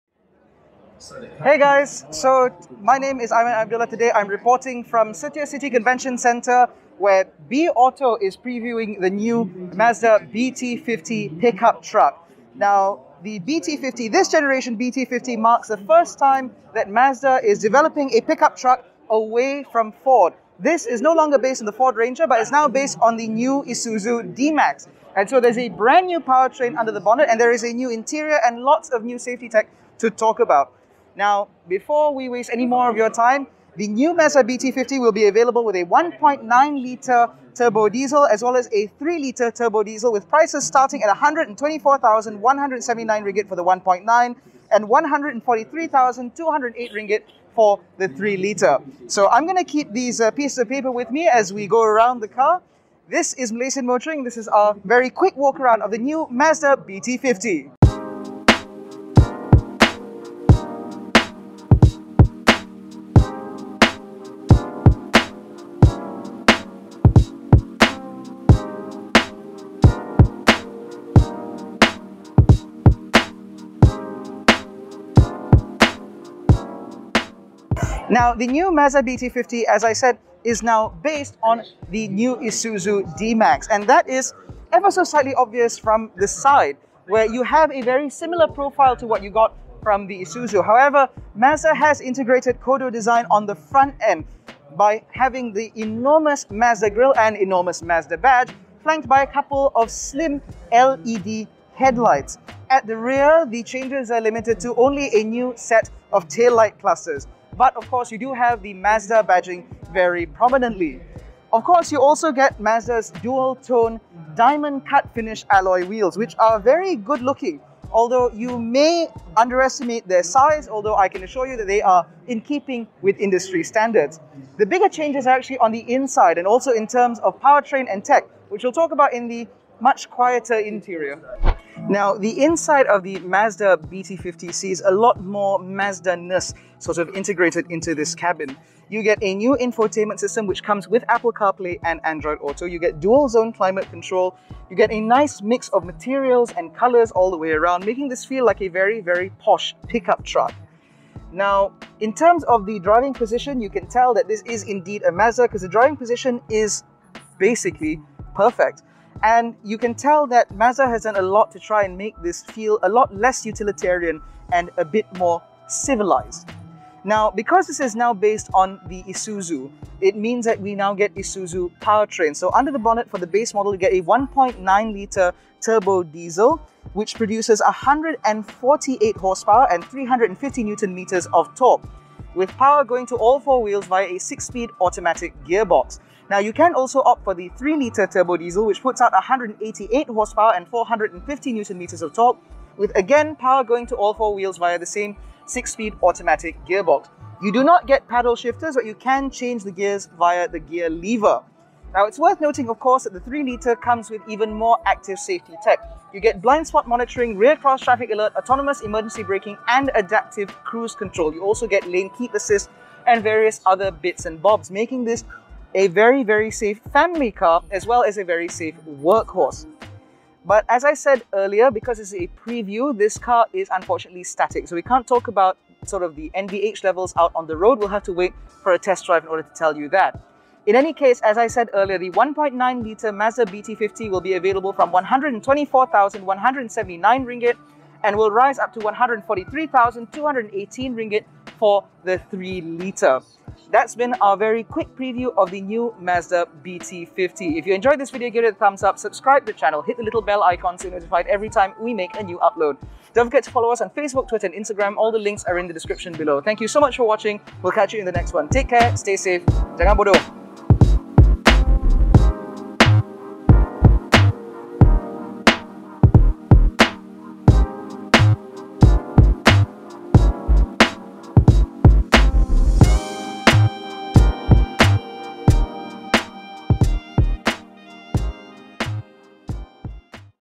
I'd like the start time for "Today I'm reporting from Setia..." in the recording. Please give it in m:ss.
0:03.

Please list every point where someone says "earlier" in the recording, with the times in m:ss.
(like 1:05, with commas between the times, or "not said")
3:41, 3:51.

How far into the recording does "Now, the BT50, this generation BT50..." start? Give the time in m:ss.
0:12.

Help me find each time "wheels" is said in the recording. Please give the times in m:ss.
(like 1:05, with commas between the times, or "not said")
1:55, 3:03, 3:14.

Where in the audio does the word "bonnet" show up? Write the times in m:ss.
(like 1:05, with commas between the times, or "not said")
0:27, 2:52.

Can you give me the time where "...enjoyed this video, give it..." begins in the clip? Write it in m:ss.
4:07.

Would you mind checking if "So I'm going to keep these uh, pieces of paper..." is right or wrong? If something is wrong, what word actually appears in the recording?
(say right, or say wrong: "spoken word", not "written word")
right.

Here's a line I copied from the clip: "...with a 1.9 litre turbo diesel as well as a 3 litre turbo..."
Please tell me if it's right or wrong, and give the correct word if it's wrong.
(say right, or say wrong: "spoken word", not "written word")
right.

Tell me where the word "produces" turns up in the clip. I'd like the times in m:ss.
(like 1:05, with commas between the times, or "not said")
2:57.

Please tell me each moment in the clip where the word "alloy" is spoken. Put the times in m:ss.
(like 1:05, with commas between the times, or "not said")
1:55.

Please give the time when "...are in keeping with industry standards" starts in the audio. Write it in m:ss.
2:01.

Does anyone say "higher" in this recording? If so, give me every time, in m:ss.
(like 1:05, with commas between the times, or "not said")
not said.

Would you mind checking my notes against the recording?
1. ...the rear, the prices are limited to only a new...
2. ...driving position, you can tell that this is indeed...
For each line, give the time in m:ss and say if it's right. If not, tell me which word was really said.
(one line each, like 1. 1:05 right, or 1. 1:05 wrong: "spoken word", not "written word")
1. 1:42 wrong: "changes", not "prices"
2. 2:32 right.